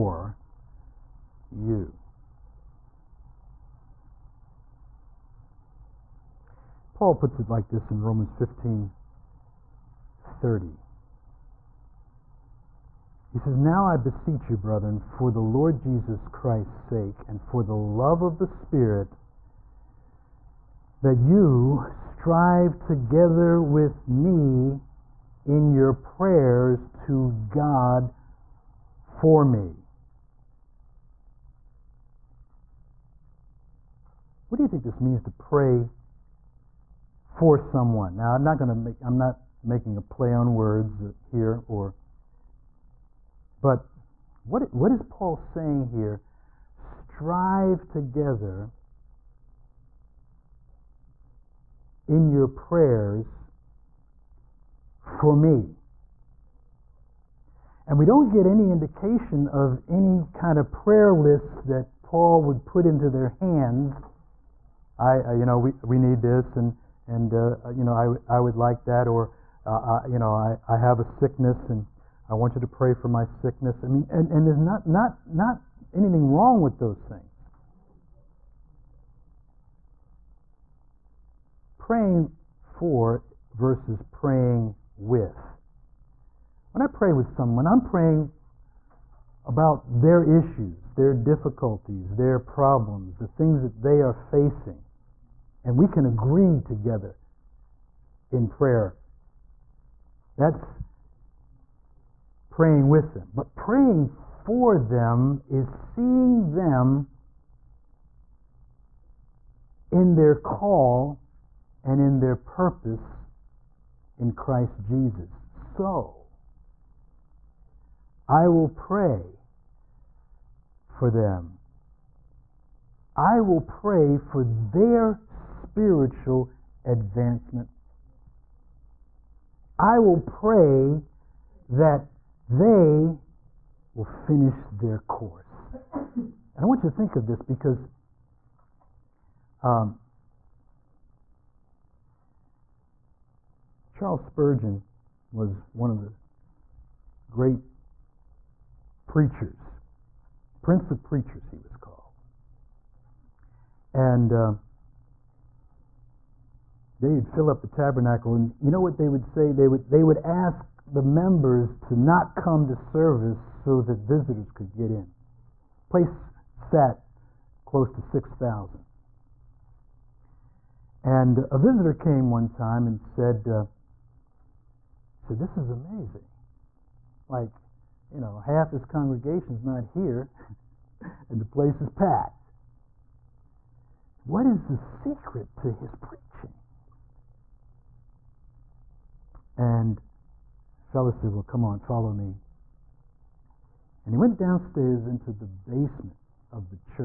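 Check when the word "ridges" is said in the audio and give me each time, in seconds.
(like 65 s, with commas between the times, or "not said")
not said.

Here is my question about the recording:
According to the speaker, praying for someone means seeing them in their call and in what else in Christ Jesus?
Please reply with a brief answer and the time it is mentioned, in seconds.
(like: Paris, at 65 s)
their purpose, at 112 s.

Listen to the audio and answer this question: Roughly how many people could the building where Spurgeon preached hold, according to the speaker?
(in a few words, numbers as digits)
6,000.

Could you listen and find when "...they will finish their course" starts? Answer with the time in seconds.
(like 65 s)
132 s.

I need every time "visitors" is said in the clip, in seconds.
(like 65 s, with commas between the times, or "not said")
163 s, 171 s.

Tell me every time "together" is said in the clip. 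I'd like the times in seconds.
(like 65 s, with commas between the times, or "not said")
22 s, 47 s, 96 s.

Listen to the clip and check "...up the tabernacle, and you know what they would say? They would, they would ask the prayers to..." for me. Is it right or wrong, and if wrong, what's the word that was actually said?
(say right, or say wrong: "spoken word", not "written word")
wrong: "members", not "prayers".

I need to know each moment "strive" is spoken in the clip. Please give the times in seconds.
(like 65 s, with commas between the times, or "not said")
21 s, 46 s.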